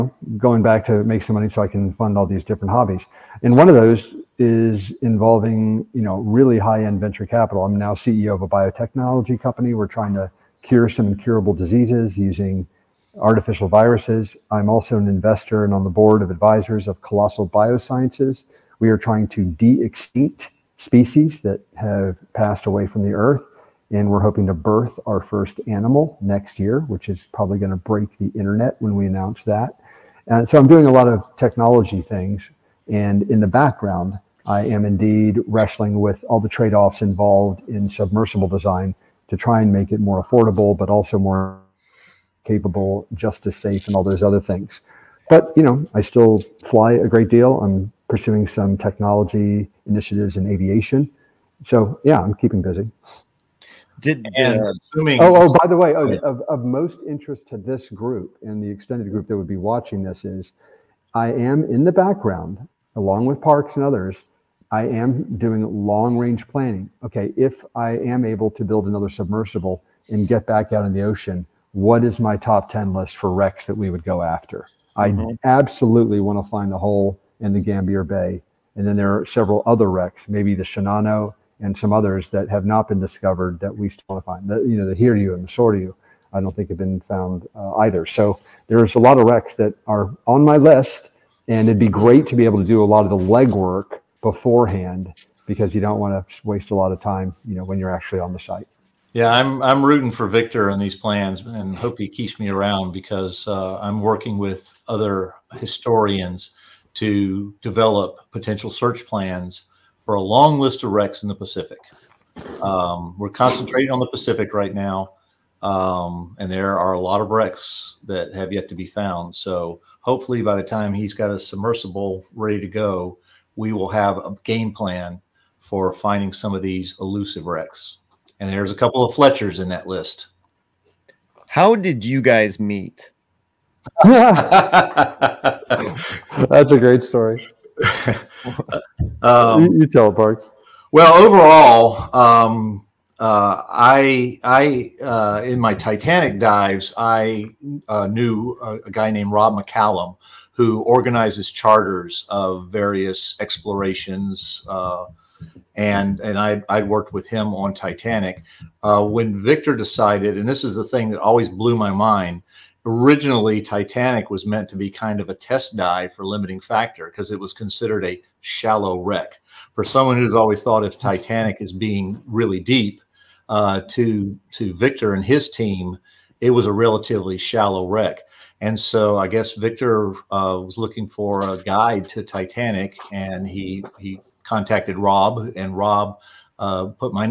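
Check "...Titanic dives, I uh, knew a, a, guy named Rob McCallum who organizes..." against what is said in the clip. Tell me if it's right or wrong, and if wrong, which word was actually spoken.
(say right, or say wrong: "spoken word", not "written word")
right.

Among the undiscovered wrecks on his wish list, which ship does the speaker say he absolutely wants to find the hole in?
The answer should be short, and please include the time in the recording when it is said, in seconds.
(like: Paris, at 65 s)
Gambier Bay, at 77 s.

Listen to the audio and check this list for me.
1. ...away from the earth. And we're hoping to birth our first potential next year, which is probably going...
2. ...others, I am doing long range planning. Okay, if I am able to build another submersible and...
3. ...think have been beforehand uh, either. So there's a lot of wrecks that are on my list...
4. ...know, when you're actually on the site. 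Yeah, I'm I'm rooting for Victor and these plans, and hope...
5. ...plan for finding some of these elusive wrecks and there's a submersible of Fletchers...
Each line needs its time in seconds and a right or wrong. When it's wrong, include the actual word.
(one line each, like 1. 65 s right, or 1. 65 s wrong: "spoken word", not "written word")
1. 22 s wrong: "animal", not "potential"
2. 63 s right
3. 86 s wrong: "found", not "beforehand"
4. 97 s right
5. 124 s wrong: "couple", not "submersible".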